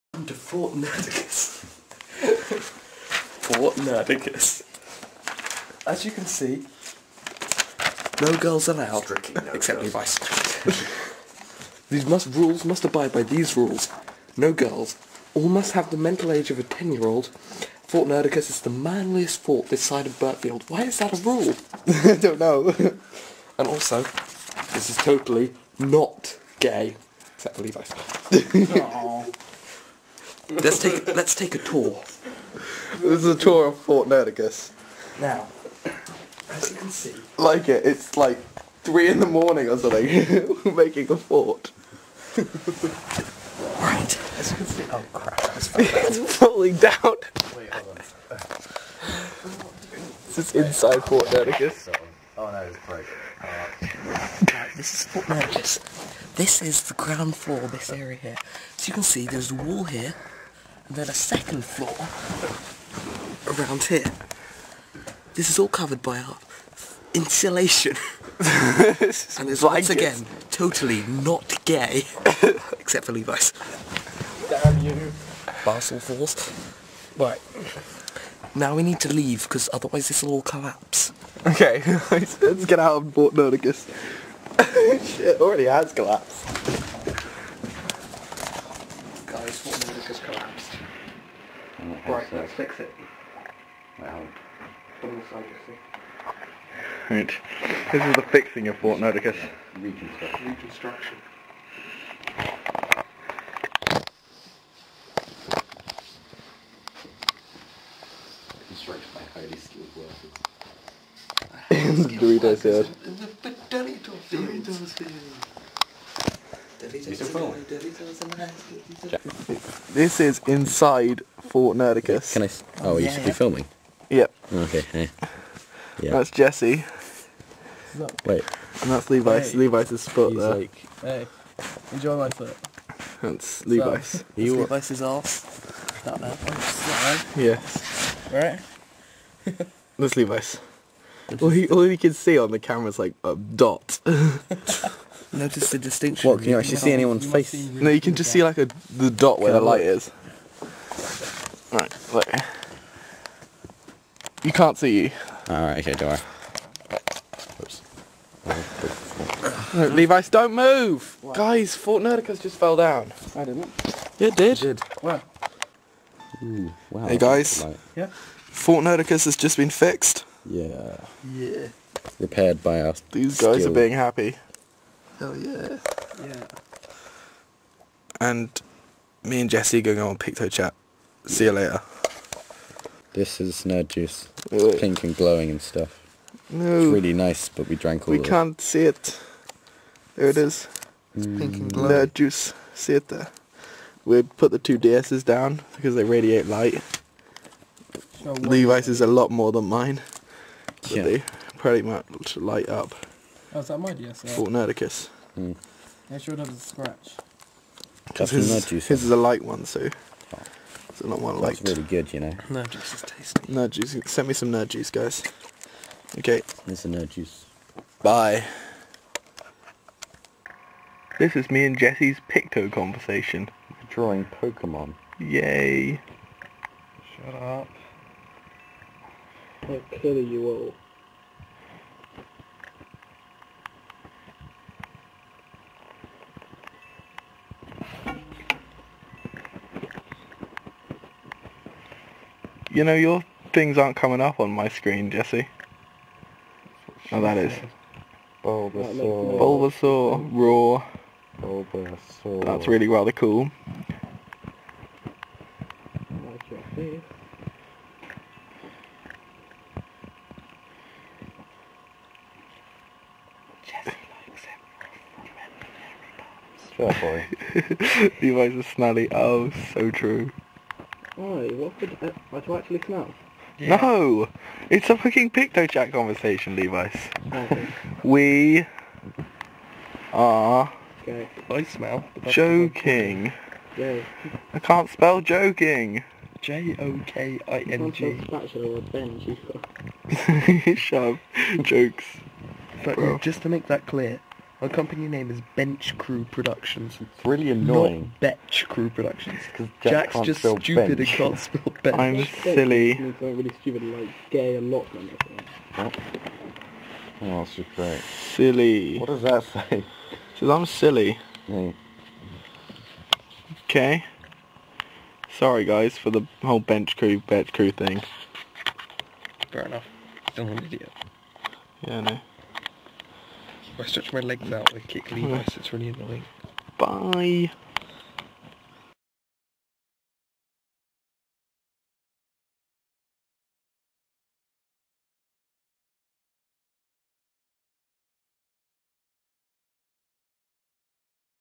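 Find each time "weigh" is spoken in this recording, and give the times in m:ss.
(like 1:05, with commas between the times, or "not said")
not said.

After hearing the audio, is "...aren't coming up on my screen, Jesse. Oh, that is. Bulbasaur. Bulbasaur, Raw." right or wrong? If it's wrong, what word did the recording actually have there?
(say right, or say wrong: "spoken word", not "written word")
right.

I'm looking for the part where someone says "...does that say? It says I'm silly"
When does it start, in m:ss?
5:09.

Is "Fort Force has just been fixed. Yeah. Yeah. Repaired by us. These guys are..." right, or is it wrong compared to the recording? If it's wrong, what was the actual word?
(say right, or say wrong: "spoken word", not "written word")
wrong: "Nerdacus", not "Force".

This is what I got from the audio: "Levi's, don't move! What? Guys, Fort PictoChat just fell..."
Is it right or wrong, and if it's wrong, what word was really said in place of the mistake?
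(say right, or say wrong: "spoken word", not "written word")
wrong: "Nerdacus", not "PictoChat".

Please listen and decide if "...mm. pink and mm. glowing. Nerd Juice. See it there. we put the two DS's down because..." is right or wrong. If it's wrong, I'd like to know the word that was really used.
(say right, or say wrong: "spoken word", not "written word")
right.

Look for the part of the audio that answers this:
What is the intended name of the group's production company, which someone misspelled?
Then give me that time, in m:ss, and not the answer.
4:55.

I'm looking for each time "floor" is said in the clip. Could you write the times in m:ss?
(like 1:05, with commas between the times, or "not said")
0:57, 1:01.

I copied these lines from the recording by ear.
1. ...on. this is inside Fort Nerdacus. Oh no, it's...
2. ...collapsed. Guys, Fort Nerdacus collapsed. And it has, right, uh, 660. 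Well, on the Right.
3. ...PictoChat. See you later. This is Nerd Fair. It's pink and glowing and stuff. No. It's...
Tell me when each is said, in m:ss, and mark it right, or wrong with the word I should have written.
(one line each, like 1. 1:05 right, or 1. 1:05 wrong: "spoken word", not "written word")
1. 0:47 right
2. 1:25 right
3. 3:00 wrong: "Juice", not "Fair".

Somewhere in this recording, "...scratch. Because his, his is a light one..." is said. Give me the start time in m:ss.
3:26.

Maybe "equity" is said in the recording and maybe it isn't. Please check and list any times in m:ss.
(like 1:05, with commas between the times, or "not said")
not said.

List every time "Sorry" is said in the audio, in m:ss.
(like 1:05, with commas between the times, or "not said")
5:15.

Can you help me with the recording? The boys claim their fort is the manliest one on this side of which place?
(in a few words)
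Burtfield.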